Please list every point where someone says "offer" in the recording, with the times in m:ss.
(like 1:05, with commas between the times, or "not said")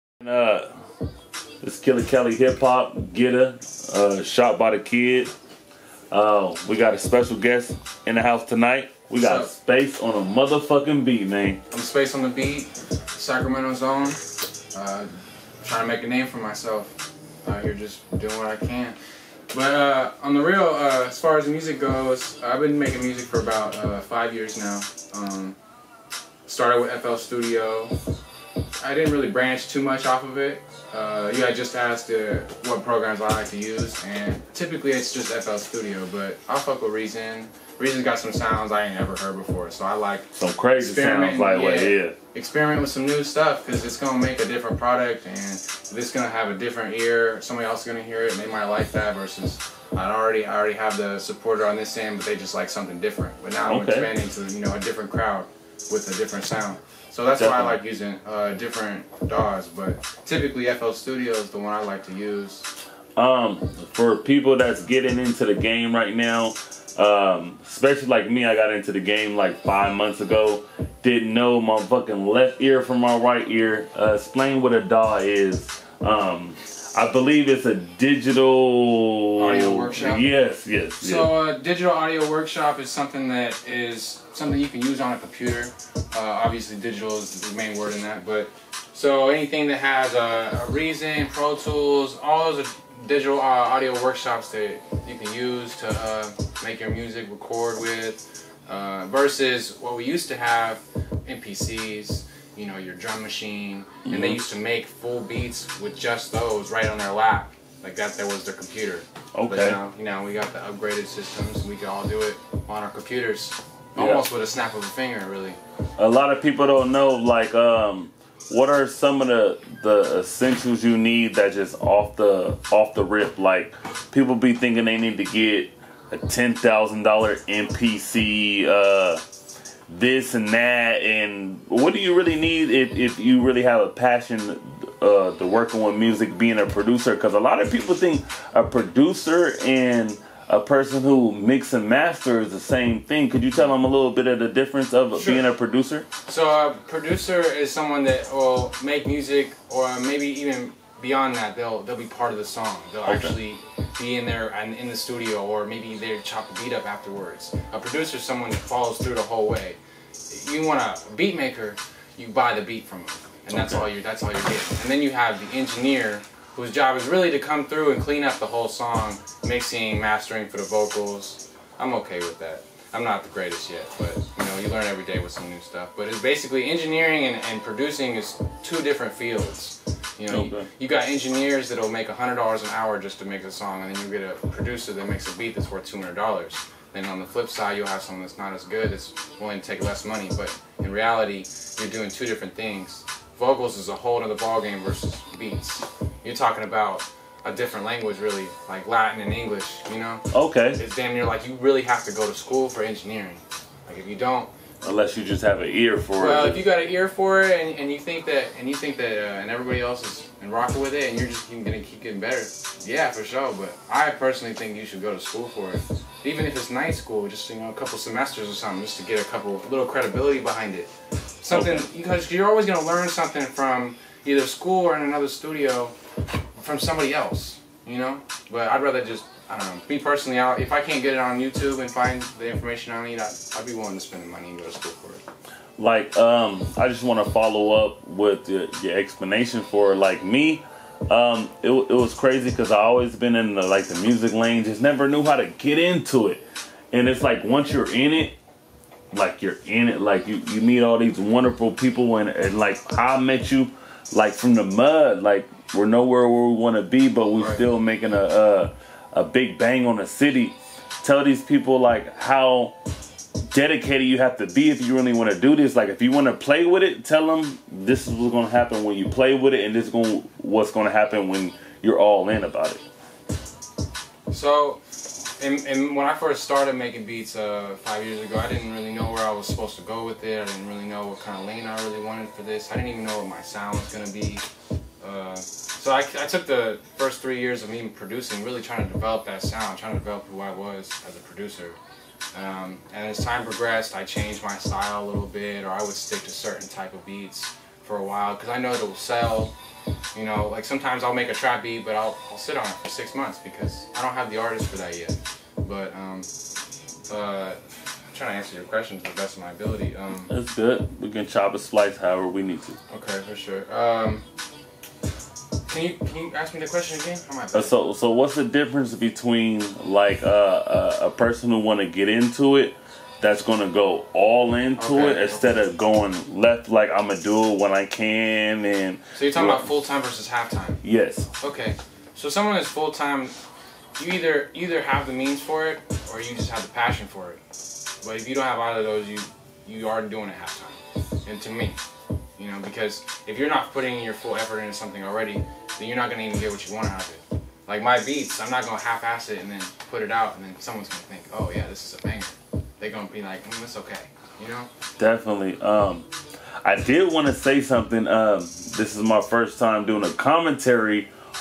not said.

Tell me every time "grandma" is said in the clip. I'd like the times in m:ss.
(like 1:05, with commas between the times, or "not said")
not said.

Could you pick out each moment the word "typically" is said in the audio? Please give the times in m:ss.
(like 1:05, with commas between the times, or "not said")
0:34, 1:00.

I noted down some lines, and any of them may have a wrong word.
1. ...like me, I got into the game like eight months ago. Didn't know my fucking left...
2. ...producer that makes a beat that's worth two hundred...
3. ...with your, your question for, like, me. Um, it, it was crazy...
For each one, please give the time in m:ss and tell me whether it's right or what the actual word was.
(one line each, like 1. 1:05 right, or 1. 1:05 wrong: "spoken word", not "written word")
1. 1:08 wrong: "five", not "eight"
2. 3:04 right
3. 3:58 wrong: "explanation", not "question".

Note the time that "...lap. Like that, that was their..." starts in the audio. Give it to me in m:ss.
1:47.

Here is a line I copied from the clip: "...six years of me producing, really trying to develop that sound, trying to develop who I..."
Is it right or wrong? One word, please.
wrong.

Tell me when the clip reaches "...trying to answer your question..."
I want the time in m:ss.
5:08.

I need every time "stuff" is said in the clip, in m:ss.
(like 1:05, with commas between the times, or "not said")
0:43, 2:55.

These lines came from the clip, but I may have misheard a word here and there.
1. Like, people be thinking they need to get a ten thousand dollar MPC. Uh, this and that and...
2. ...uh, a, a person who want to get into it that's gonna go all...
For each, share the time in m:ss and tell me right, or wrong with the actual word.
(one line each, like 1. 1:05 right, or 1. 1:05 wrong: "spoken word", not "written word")
1. 2:03 right
2. 5:20 right.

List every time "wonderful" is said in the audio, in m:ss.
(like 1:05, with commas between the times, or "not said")
4:11.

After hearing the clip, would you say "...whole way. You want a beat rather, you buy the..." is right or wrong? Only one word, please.
wrong.